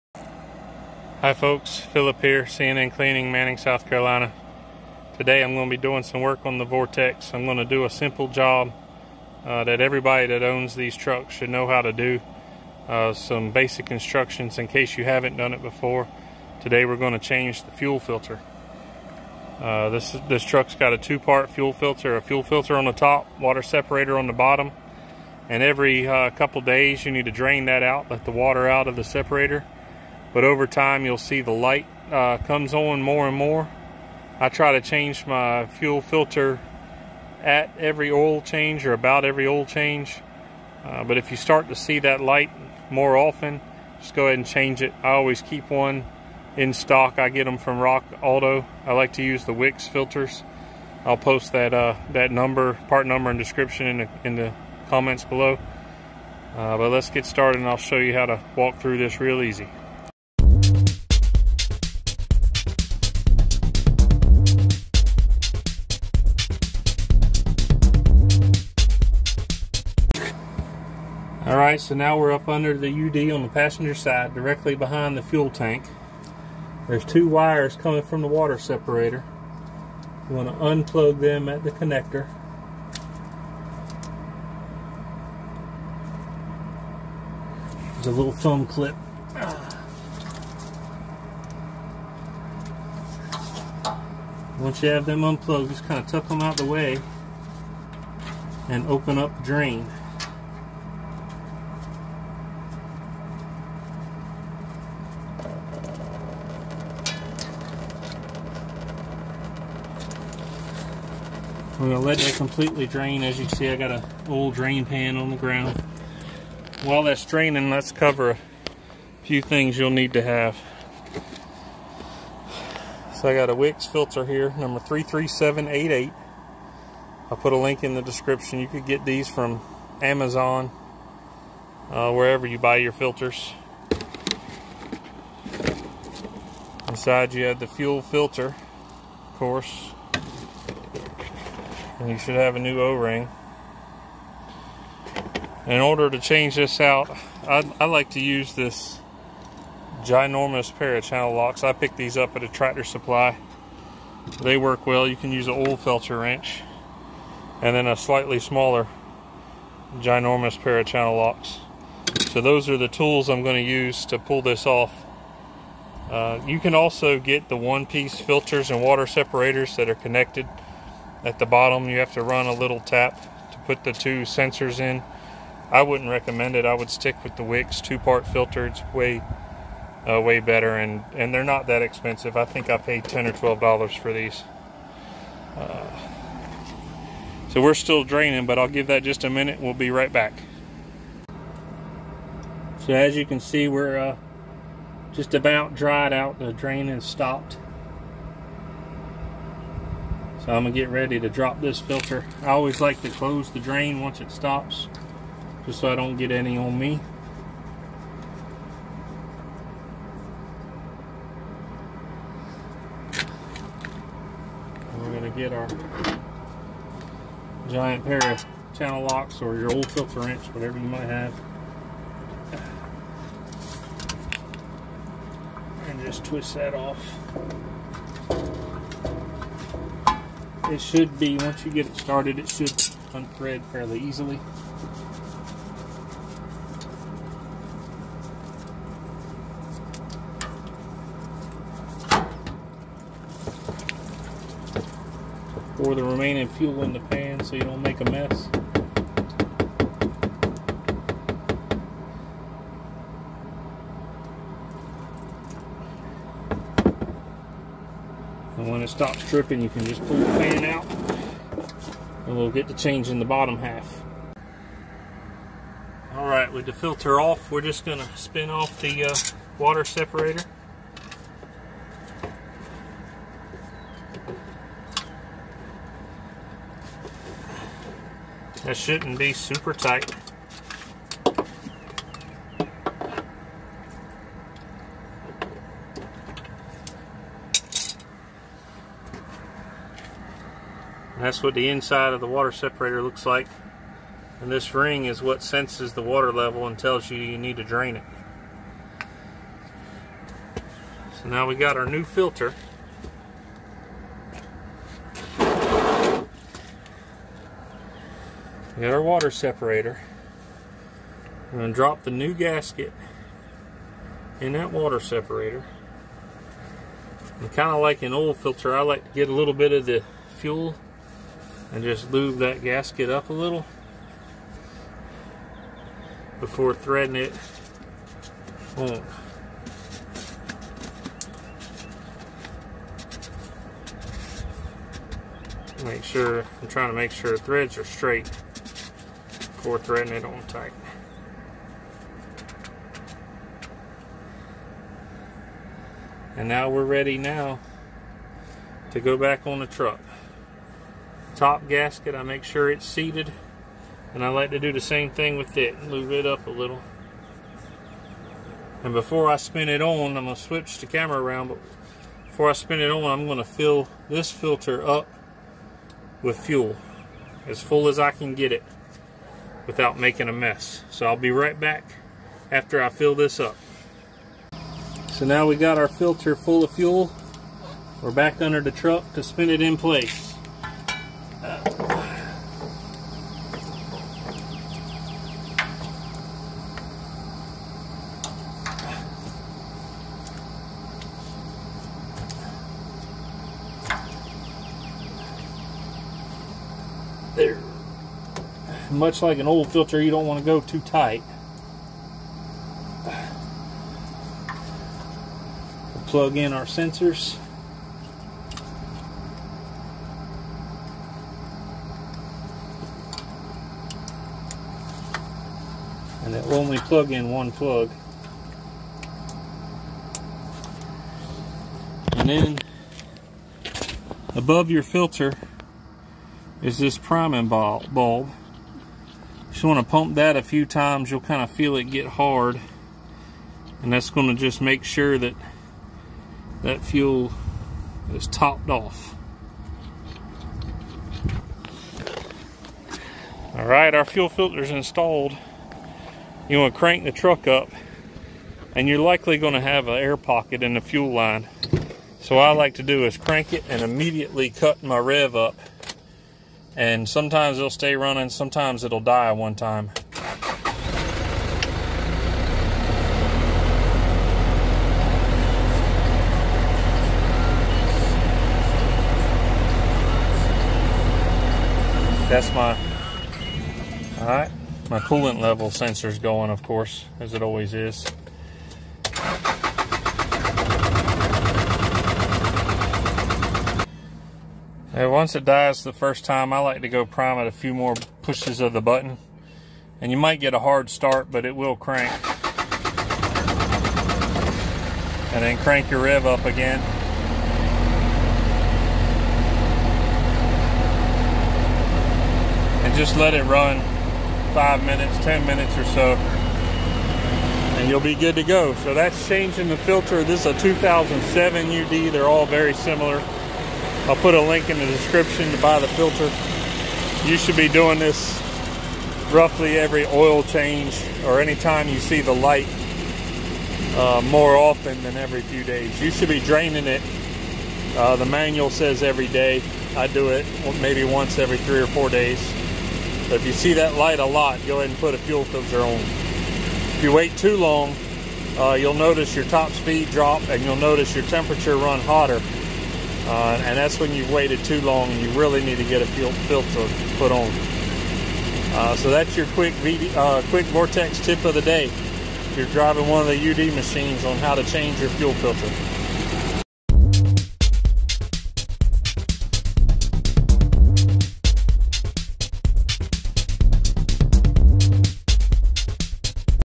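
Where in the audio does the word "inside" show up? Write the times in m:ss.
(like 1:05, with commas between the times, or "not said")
2:16, 4:51.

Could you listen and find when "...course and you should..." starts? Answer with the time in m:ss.
2:19.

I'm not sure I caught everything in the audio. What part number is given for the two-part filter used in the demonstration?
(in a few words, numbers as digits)
33788.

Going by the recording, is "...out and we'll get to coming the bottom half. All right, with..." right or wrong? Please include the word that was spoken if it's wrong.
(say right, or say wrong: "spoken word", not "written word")
wrong: "changing", not "coming".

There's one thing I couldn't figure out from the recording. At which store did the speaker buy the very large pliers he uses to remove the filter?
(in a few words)
Tractor Supply.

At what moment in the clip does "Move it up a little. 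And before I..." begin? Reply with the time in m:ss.
5:55.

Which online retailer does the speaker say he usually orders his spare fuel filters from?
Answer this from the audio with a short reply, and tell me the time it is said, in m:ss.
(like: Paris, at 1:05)
Rock Auto, at 0:47.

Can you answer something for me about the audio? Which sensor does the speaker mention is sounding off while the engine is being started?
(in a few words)
coolant level sensor.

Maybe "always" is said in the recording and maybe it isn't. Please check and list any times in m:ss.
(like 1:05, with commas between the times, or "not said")
0:45, 3:22, 7:57.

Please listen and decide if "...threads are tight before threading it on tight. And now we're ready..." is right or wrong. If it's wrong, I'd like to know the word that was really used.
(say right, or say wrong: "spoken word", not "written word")
wrong: "straight", not "tight".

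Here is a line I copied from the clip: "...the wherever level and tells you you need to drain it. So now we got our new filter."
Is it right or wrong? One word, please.
wrong.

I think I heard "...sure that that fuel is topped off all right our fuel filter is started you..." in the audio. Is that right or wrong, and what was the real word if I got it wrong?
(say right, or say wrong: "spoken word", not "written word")
wrong: "installed", not "started".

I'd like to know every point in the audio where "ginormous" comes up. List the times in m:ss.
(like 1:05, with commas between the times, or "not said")
2:30, 2:39.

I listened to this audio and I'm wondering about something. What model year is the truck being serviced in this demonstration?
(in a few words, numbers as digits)
2007.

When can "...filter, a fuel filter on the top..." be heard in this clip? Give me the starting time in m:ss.
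0:21.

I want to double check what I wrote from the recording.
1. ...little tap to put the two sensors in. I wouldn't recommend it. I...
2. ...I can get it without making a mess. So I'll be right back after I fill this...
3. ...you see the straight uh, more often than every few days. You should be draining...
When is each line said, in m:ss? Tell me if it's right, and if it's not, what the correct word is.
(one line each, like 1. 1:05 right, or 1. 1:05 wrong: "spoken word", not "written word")
1. 2:52 right
2. 6:07 right
3. 8:41 wrong: "light", not "straight".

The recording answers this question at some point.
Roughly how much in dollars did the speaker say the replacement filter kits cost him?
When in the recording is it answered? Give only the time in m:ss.
3:03.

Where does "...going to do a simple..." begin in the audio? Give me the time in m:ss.
0:07.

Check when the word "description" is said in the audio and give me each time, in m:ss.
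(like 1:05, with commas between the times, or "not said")
0:53, 2:08, 8:34.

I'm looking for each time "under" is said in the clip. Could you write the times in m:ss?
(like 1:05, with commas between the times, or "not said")
1:12, 6:18.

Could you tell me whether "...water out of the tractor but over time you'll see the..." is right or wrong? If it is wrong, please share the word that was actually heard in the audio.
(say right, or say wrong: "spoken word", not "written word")
wrong: "separator", not "tractor".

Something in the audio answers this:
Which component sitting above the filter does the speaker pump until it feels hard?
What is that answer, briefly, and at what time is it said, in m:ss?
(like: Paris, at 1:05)
priming bulb, at 7:06.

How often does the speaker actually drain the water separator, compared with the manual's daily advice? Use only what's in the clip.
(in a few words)
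every 3 or 4 days.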